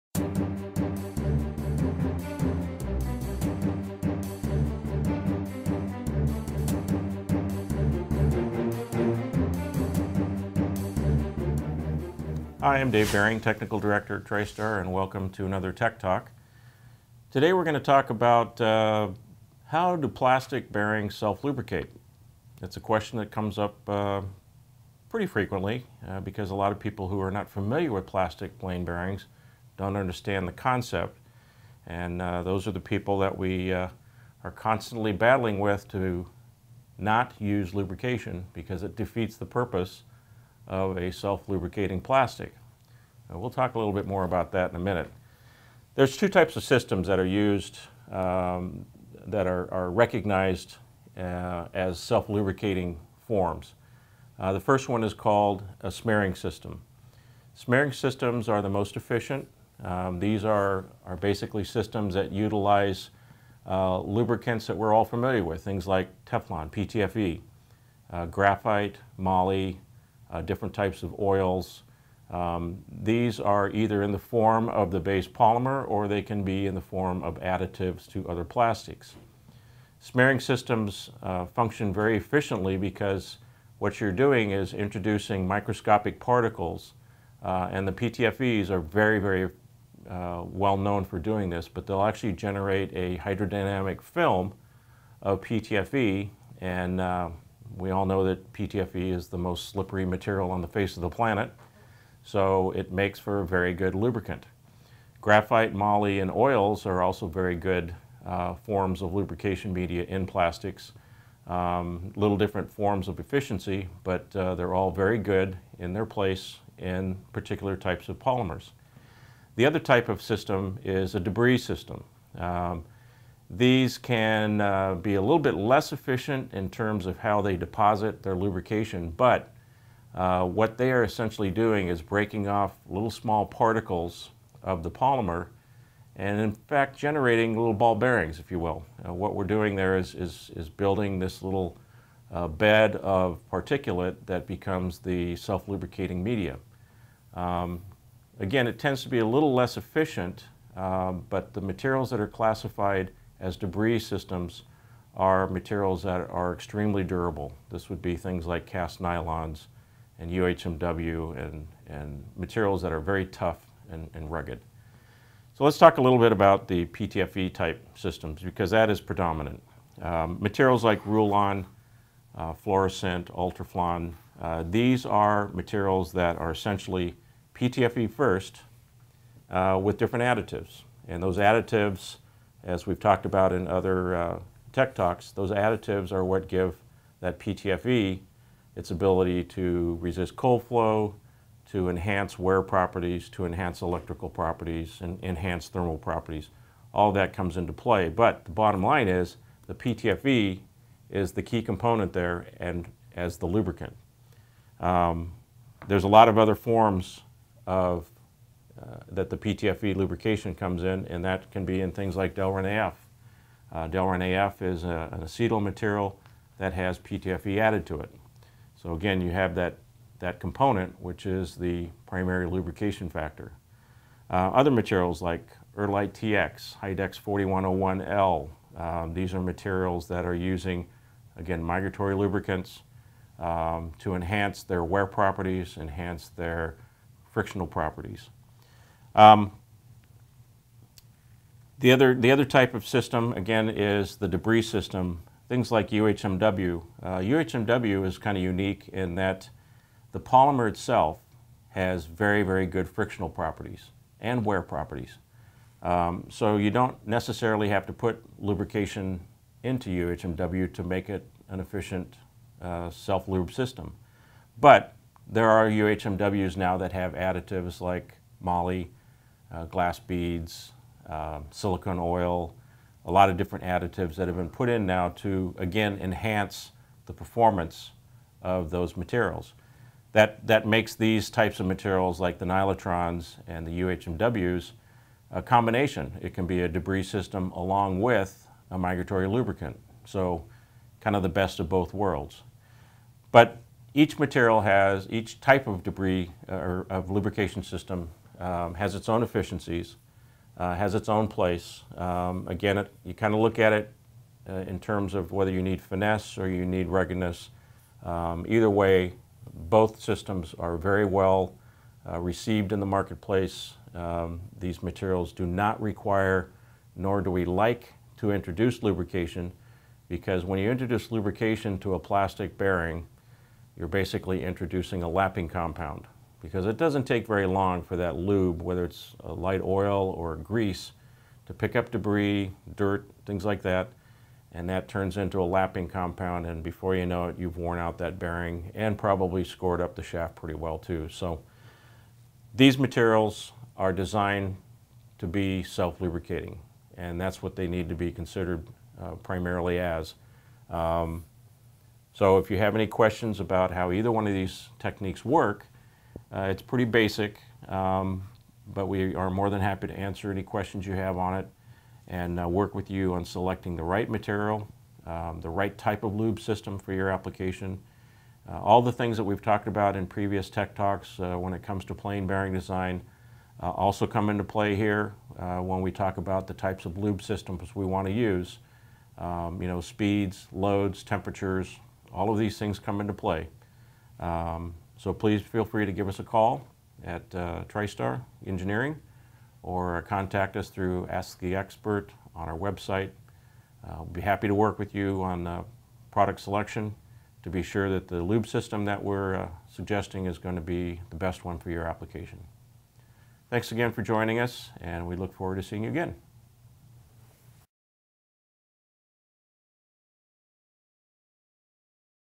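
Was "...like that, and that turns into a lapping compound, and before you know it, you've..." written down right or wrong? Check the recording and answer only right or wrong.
right.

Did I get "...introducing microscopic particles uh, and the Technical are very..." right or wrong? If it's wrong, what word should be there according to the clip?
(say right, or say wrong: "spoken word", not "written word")
wrong: "PTFEs", not "Technical".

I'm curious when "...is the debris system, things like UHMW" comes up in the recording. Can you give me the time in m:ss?
4:03.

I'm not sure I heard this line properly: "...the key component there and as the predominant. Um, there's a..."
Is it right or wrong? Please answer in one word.
wrong.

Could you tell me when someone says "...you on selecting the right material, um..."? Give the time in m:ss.
6:02.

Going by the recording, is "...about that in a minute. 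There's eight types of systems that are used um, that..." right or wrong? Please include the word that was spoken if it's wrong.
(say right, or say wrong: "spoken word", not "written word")
wrong: "two", not "eight".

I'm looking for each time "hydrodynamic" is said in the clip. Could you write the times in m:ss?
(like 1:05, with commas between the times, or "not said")
1:33.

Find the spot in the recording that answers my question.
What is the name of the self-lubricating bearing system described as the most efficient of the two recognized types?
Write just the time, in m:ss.
0:55.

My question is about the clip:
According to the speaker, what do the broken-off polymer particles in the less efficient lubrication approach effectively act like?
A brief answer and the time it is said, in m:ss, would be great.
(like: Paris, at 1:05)
Little ball bearings, at 2:17.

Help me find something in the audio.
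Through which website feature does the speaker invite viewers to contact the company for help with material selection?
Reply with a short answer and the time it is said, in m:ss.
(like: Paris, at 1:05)
Ask the Expert, at 6:31.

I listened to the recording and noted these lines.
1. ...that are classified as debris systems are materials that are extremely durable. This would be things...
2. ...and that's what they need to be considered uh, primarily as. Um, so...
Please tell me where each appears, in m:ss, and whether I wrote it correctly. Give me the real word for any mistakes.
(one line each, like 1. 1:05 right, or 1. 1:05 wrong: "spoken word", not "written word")
1. 2:32 right
2. 5:46 right.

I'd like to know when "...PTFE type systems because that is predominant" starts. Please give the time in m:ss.
2:46.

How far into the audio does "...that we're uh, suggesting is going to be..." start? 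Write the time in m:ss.
6:38.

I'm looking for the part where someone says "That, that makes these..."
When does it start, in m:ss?
4:40.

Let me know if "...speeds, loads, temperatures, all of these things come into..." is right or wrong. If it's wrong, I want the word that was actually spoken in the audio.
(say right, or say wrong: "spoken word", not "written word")
right.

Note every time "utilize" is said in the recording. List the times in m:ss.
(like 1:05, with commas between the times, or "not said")
1:02.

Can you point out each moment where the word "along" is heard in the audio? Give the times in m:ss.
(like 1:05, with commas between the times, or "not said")
4:47.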